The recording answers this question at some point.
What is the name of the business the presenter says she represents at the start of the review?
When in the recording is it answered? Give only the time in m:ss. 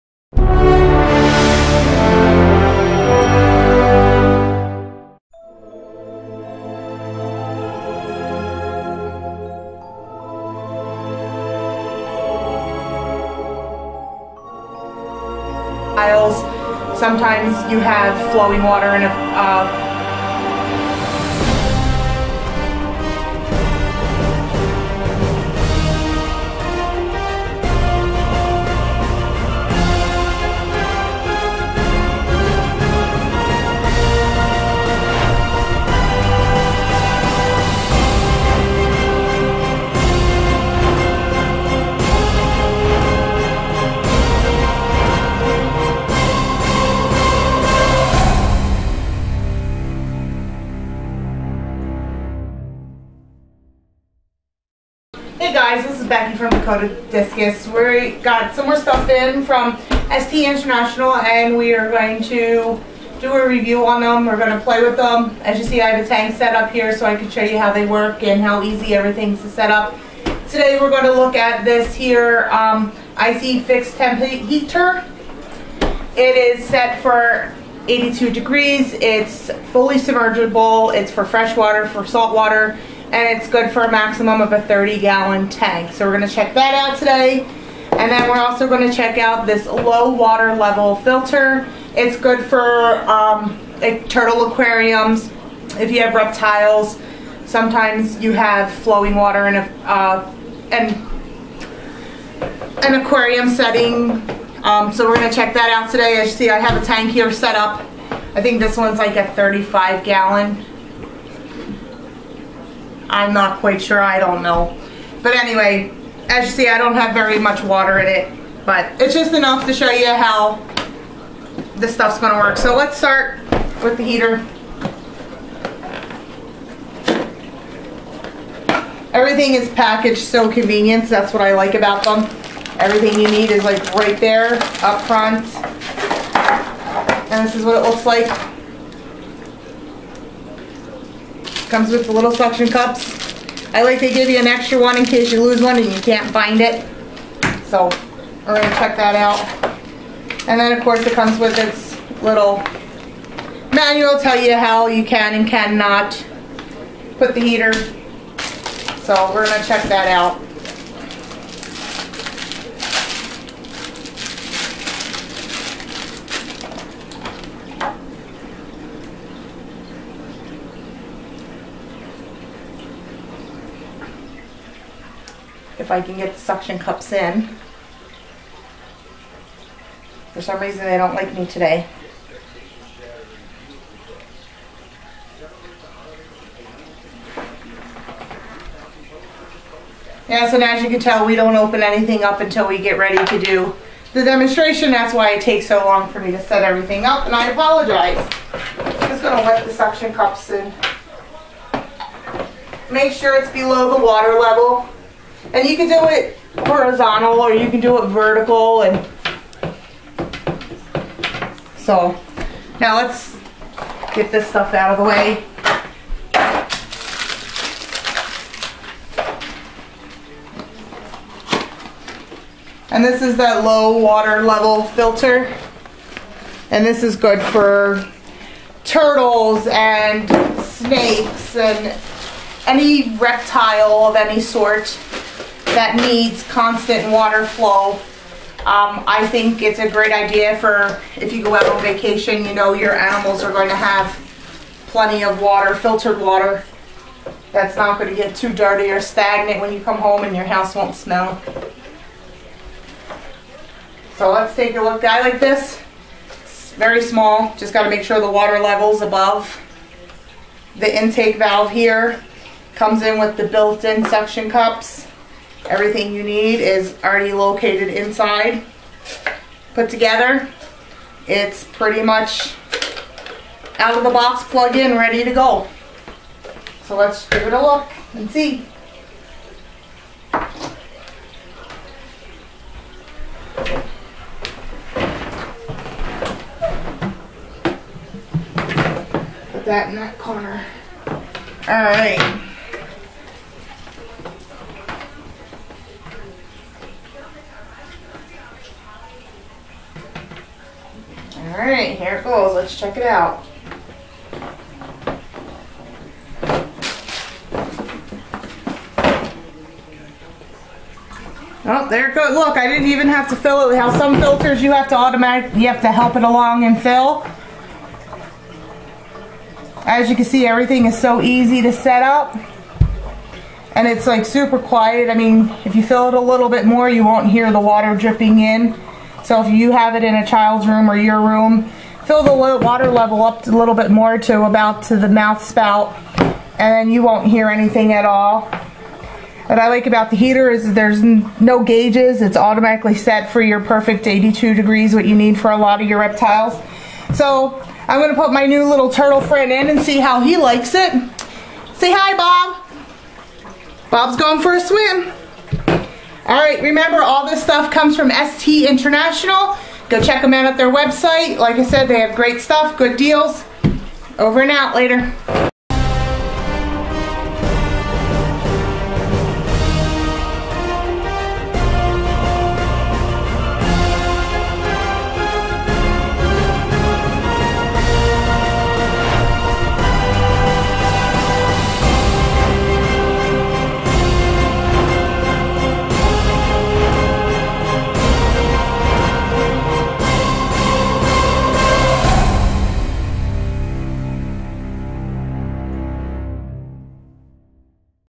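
0:56.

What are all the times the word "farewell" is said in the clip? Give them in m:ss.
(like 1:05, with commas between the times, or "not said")
not said.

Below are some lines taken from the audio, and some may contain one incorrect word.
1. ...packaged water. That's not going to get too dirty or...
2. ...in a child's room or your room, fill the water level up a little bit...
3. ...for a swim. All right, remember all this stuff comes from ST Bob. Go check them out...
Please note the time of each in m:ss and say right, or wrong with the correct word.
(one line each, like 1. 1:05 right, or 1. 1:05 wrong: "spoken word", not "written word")
1. 4:05 wrong: "filtered", not "packaged"
2. 5:30 right
3. 5:54 wrong: "International", not "Bob".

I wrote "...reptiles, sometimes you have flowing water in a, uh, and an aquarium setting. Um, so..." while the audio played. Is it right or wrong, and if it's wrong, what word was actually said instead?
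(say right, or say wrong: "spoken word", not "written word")
right.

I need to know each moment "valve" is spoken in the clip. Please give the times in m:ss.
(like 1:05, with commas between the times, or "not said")
4:21.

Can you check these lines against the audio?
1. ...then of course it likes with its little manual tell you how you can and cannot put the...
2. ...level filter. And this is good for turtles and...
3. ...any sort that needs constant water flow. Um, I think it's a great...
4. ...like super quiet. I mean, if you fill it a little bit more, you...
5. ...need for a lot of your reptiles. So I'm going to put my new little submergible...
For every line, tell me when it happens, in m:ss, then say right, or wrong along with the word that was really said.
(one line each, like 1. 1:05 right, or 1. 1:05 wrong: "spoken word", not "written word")
1. 2:30 wrong: "comes", not "likes"
2. 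3:44 right
3. 3:54 right
4. 5:24 right
5. 5:45 wrong: "turtle", not "submergible".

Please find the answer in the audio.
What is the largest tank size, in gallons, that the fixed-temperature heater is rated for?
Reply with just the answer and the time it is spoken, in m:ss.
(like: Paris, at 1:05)
30 gallon, at 1:24.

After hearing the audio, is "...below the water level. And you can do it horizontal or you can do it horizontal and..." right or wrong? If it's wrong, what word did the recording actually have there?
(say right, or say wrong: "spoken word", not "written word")
wrong: "vertical", not "horizontal".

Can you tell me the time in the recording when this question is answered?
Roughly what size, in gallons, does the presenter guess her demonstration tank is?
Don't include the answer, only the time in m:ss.
1:49.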